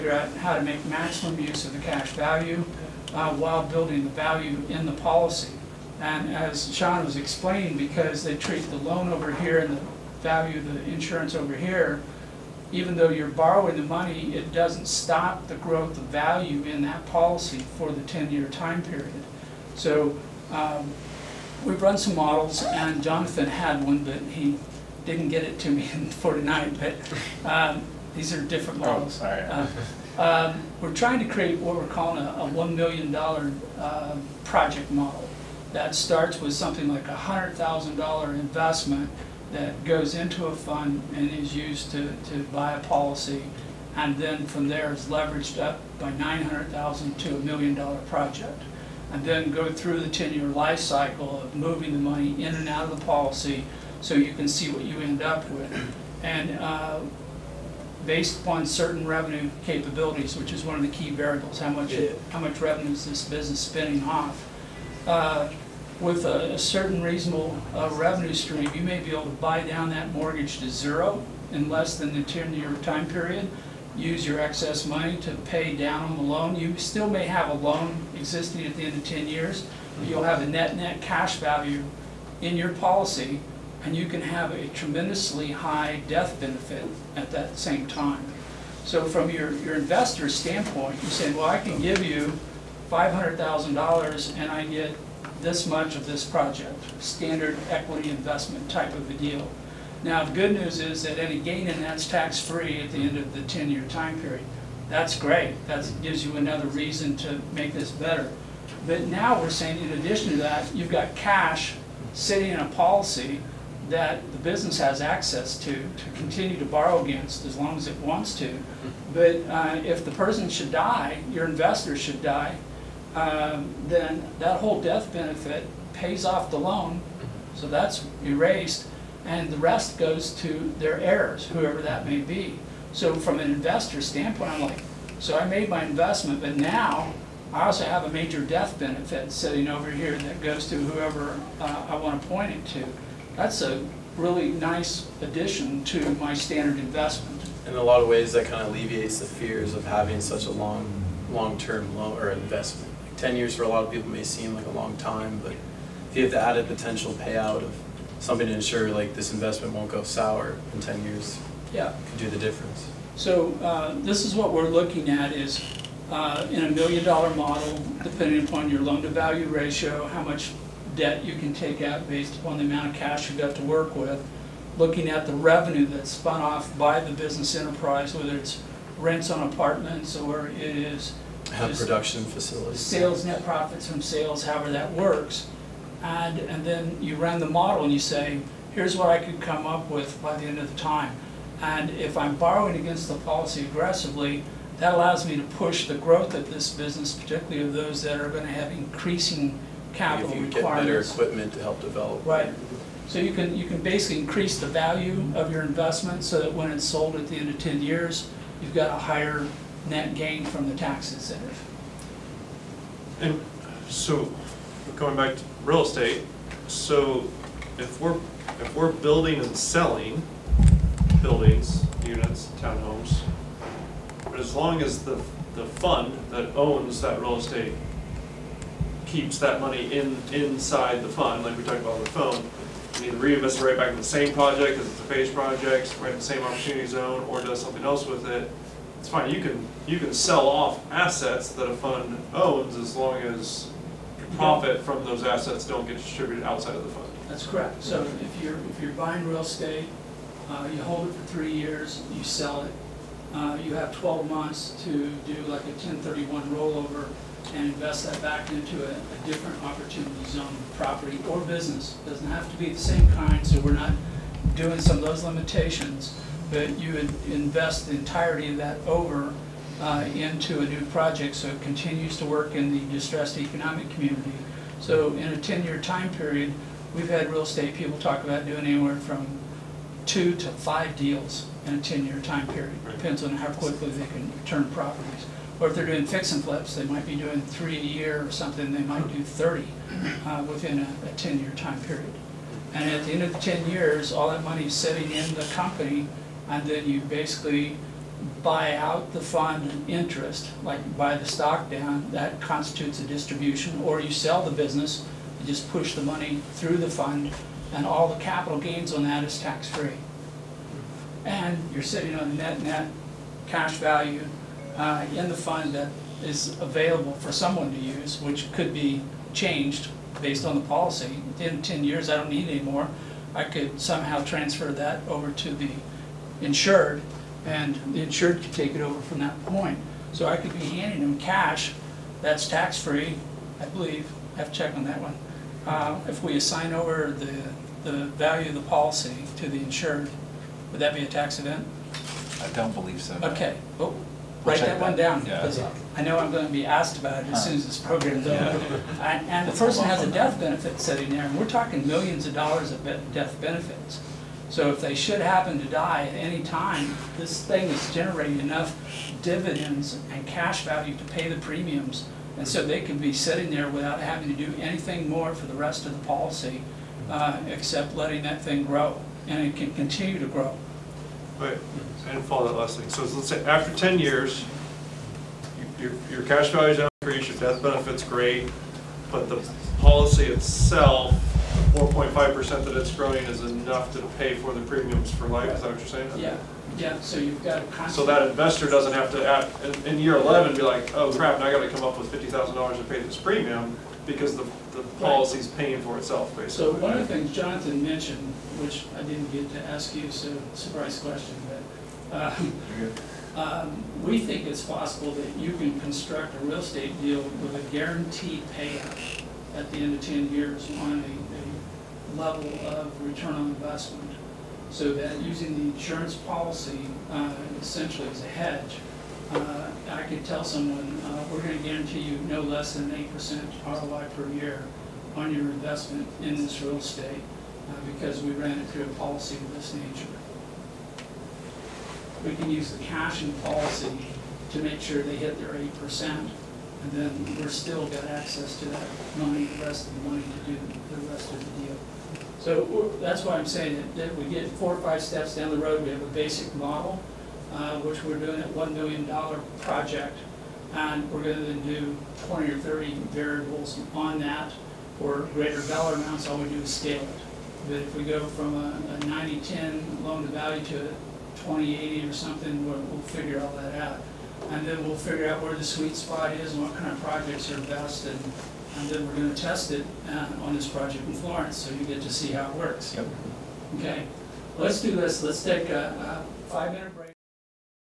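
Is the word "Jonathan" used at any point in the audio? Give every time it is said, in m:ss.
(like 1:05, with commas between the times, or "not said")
0:23, 6:37.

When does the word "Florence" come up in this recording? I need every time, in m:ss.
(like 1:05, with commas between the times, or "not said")
7:51.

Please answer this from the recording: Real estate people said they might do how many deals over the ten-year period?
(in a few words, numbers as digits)
two to five.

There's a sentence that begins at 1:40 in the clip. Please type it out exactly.
Now, the good news is that any gain in that's tax-free at the end of the 10-year time period.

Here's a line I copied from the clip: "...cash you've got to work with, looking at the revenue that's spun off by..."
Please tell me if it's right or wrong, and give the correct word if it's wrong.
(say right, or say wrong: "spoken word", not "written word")
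right.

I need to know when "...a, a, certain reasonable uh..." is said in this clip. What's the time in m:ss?
1:06.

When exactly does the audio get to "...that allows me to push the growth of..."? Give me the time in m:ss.
3:14.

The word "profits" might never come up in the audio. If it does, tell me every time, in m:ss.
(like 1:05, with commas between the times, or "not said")
3:03, 4:04.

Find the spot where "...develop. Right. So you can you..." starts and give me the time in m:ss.
3:21.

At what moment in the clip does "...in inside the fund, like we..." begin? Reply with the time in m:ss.
3:49.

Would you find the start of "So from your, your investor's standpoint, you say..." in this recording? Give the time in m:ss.
1:28.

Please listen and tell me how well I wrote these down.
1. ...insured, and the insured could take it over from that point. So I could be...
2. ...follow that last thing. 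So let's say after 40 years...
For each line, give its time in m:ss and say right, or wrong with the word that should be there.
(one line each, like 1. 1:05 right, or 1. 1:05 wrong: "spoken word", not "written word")
1. 5:26 right
2. 6:12 wrong: "10", not "40".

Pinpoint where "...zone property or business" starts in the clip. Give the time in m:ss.
4:20.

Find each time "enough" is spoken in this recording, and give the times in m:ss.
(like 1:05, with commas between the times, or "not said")
5:58, 6:23.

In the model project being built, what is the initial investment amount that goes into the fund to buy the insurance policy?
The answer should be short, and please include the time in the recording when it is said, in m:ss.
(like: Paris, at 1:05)
$100,000, at 0:37.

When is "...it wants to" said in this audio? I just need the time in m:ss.
1:57.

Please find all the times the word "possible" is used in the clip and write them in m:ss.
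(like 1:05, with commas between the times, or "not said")
6:44.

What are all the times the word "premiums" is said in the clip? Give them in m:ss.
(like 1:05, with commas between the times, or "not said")
6:01, 6:24, 6:33.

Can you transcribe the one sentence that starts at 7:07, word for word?
Uh, because we ran it through a policy of this nature.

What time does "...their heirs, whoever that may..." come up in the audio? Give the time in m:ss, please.
2:10.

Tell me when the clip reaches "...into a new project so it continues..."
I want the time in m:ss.
4:30.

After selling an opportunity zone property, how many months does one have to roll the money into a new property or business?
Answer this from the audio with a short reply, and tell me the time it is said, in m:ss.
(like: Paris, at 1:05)
12 months, at 4:13.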